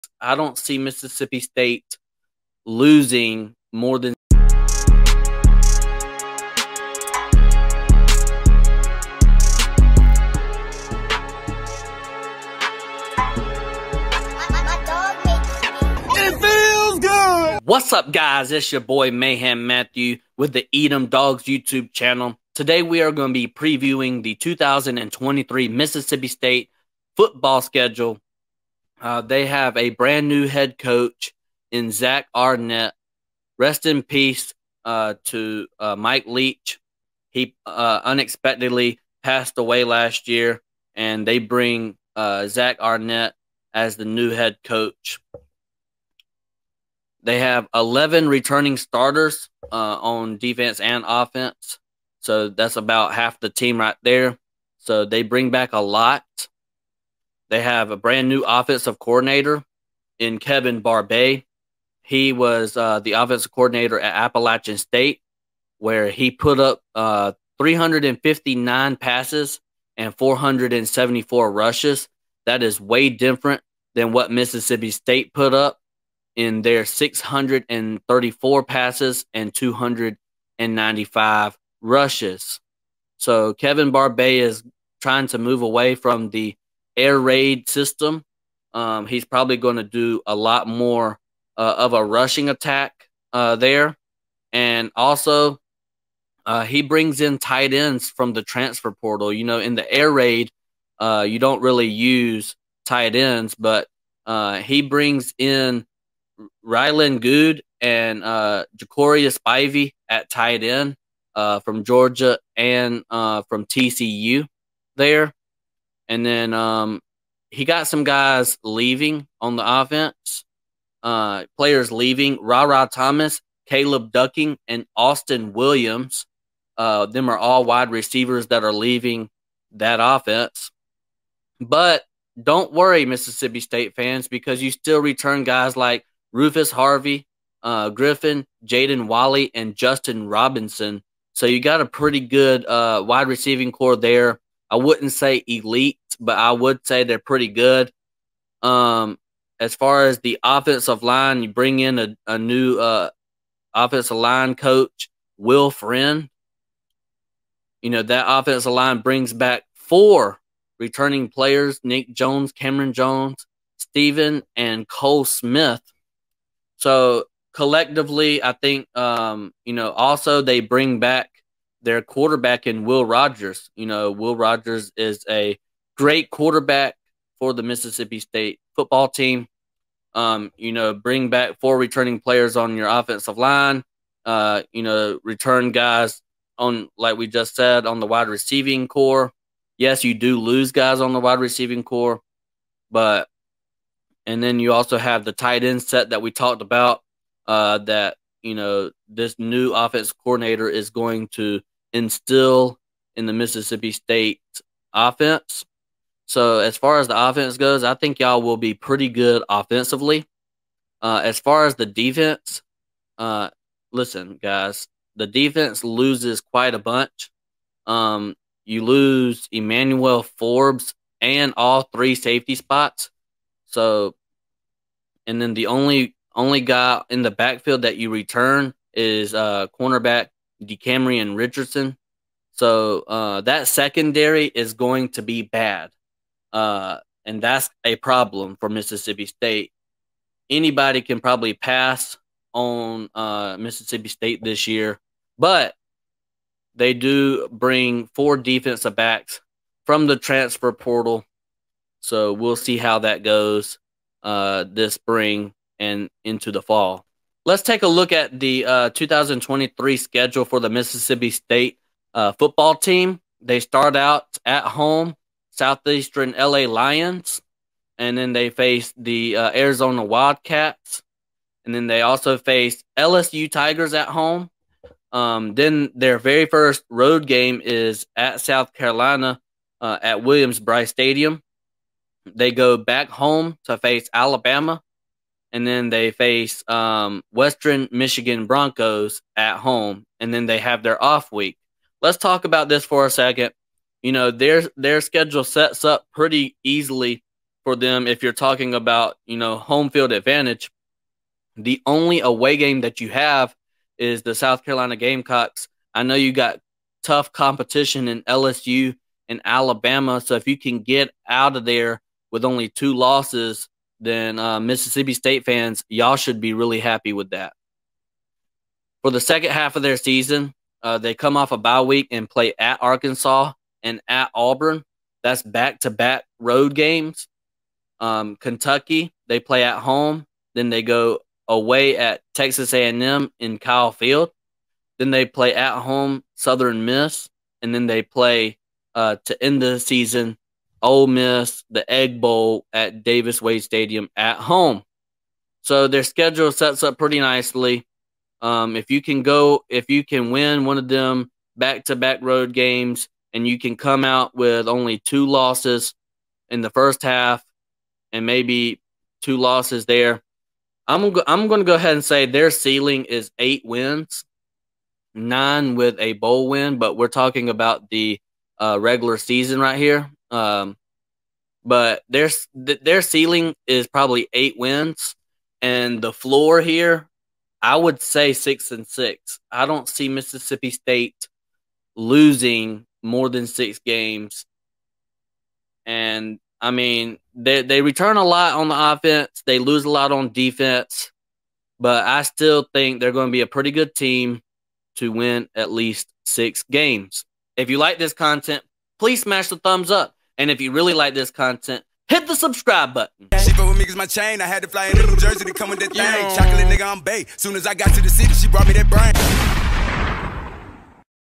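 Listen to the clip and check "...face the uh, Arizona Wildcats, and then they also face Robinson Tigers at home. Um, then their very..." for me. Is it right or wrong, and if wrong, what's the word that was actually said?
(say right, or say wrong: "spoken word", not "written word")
wrong: "LSU", not "Robinson".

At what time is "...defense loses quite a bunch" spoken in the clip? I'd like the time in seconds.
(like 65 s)
215 s.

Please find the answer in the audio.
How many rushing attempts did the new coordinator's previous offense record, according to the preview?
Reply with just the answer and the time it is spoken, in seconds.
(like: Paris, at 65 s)
474, at 70 s.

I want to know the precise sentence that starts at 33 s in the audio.
Rest in peace uh, to uh, Mike Leach.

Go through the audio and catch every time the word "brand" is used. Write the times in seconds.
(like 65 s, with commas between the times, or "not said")
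29 s, 57 s.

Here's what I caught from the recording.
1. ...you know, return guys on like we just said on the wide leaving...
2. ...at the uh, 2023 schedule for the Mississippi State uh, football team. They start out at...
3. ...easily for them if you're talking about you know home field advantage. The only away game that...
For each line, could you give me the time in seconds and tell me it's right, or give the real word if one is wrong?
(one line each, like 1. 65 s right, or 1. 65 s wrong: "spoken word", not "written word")
1. 184 s wrong: "receiving", not "leaving"
2. 258 s right
3. 296 s right.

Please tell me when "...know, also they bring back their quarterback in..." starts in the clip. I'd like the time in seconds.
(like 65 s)
169 s.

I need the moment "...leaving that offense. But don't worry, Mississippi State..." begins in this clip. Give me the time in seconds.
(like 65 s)
128 s.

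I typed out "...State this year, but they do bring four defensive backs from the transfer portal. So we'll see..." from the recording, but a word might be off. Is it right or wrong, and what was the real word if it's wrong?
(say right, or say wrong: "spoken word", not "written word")
right.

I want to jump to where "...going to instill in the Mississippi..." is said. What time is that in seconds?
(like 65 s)
200 s.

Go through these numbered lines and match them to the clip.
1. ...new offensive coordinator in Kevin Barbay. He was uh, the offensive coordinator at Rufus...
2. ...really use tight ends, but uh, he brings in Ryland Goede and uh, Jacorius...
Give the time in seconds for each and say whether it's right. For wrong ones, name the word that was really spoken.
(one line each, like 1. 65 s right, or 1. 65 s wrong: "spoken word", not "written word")
1. 58 s wrong: "Appalachian", not "Rufus"
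2. 101 s right.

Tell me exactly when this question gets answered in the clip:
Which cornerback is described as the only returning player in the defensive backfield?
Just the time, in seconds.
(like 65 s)
230 s.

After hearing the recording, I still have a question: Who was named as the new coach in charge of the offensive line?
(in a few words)
Will Friend.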